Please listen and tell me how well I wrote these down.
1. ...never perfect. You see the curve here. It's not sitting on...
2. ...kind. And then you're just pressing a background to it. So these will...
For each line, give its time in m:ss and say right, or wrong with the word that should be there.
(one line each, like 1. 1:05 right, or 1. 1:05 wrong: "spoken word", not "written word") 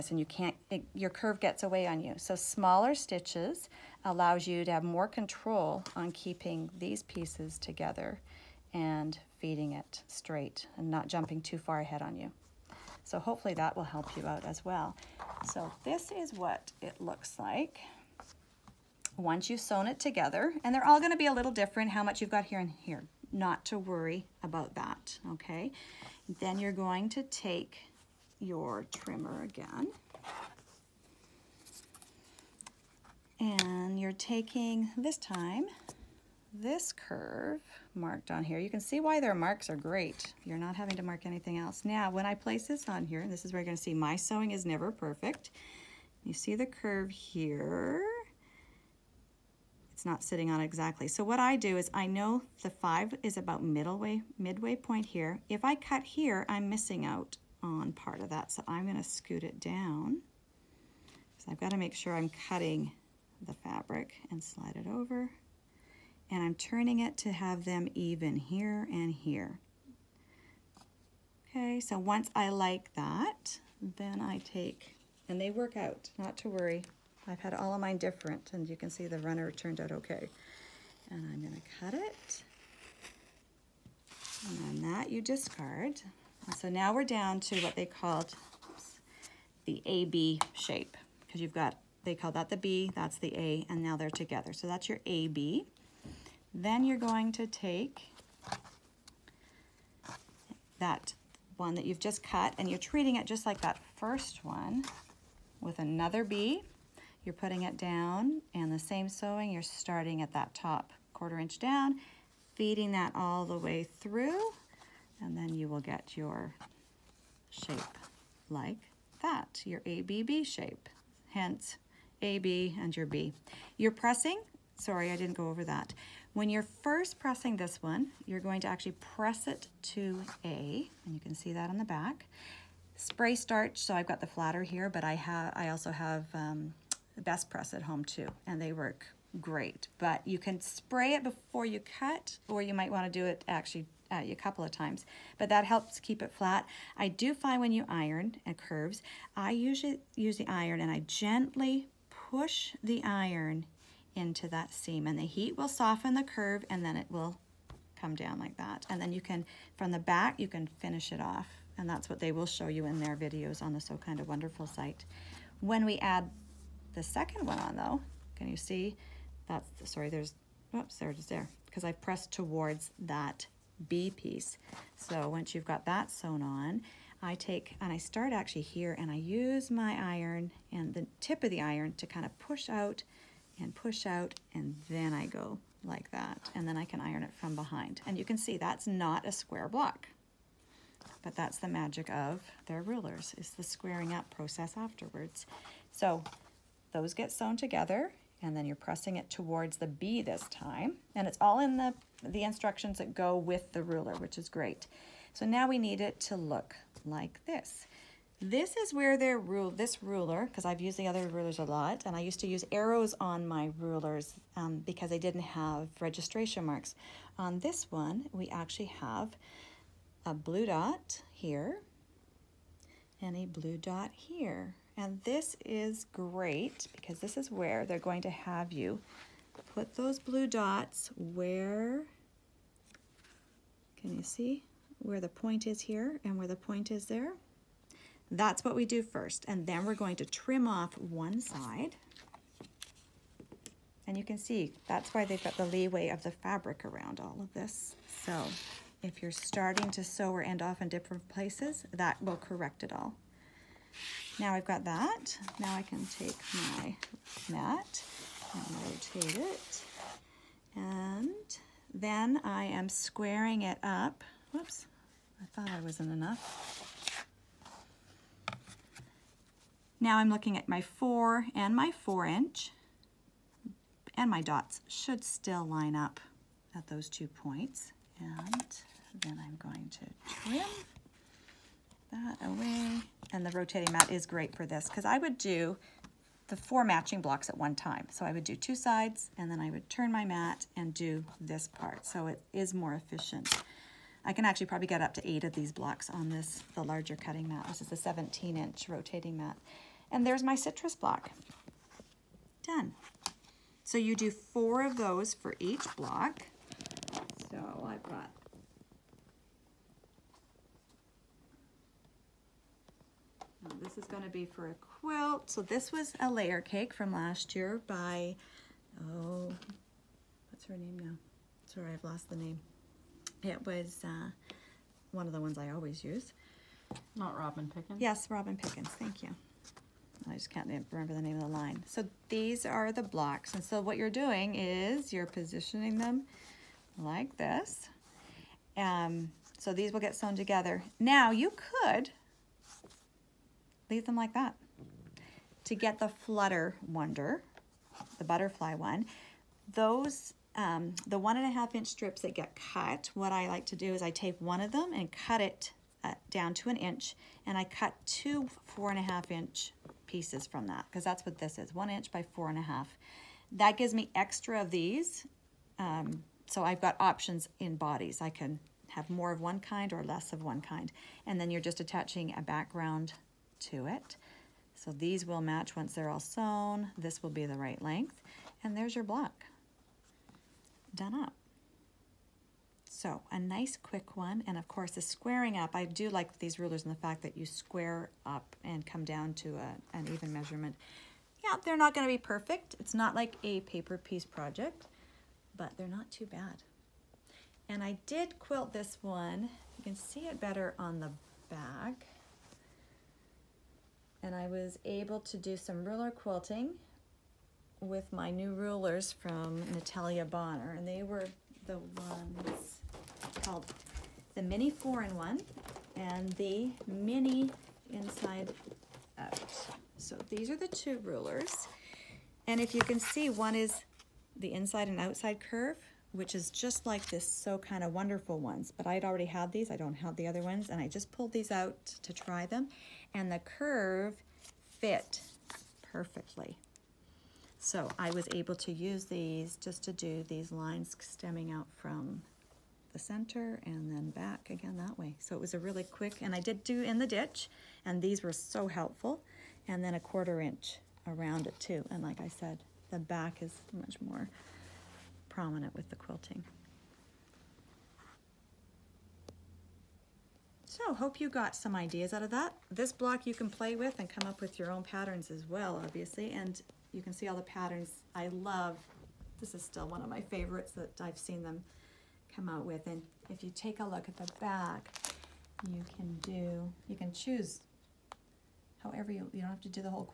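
1. 0:44 right
2. 6:10 wrong: "attaching", not "pressing".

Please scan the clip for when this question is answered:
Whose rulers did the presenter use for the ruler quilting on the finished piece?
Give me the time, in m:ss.
6:49.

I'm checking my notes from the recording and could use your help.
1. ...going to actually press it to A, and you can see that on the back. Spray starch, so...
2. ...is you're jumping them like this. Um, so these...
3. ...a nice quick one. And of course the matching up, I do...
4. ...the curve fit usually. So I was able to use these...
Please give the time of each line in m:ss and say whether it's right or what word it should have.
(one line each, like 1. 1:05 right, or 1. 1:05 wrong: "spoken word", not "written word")
1. 2:08 right
2. 5:34 wrong: "positioning", not "jumping"
3. 6:23 wrong: "squaring", not "matching"
4. 7:13 wrong: "perfectly", not "usually".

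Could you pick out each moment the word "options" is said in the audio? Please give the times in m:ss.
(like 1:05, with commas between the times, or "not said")
6:06.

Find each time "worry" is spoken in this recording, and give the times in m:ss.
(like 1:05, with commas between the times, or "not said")
0:23, 1:16.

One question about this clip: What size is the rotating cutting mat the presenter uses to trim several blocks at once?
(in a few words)
17 inch.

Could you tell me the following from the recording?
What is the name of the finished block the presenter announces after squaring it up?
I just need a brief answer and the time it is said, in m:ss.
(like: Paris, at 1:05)
Citrus block, at 5:00.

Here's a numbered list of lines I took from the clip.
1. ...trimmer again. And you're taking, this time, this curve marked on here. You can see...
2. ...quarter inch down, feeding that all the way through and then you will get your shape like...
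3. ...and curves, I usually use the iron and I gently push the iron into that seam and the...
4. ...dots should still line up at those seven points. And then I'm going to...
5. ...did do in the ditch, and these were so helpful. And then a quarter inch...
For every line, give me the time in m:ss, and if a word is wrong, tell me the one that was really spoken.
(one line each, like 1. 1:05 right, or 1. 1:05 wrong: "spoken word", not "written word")
1. 0:28 right
2. 1:51 right
3. 2:28 right
4. 4:34 wrong: "two", not "seven"
5. 7:26 right.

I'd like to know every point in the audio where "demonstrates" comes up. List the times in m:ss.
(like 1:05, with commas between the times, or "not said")
not said.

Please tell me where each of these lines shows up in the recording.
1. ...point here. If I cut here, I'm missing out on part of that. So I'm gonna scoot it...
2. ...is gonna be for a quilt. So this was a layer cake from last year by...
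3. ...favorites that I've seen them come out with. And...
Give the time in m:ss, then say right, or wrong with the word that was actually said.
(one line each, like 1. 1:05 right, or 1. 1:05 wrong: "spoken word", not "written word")
1. 0:54 right
2. 5:14 right
3. 7:50 right.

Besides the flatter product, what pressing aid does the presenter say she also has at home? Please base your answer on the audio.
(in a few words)
Best Press.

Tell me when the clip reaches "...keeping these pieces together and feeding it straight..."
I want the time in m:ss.
0:06.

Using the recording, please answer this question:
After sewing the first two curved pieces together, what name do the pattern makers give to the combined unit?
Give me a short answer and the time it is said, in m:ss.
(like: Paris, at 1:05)
AB shape, at 1:29.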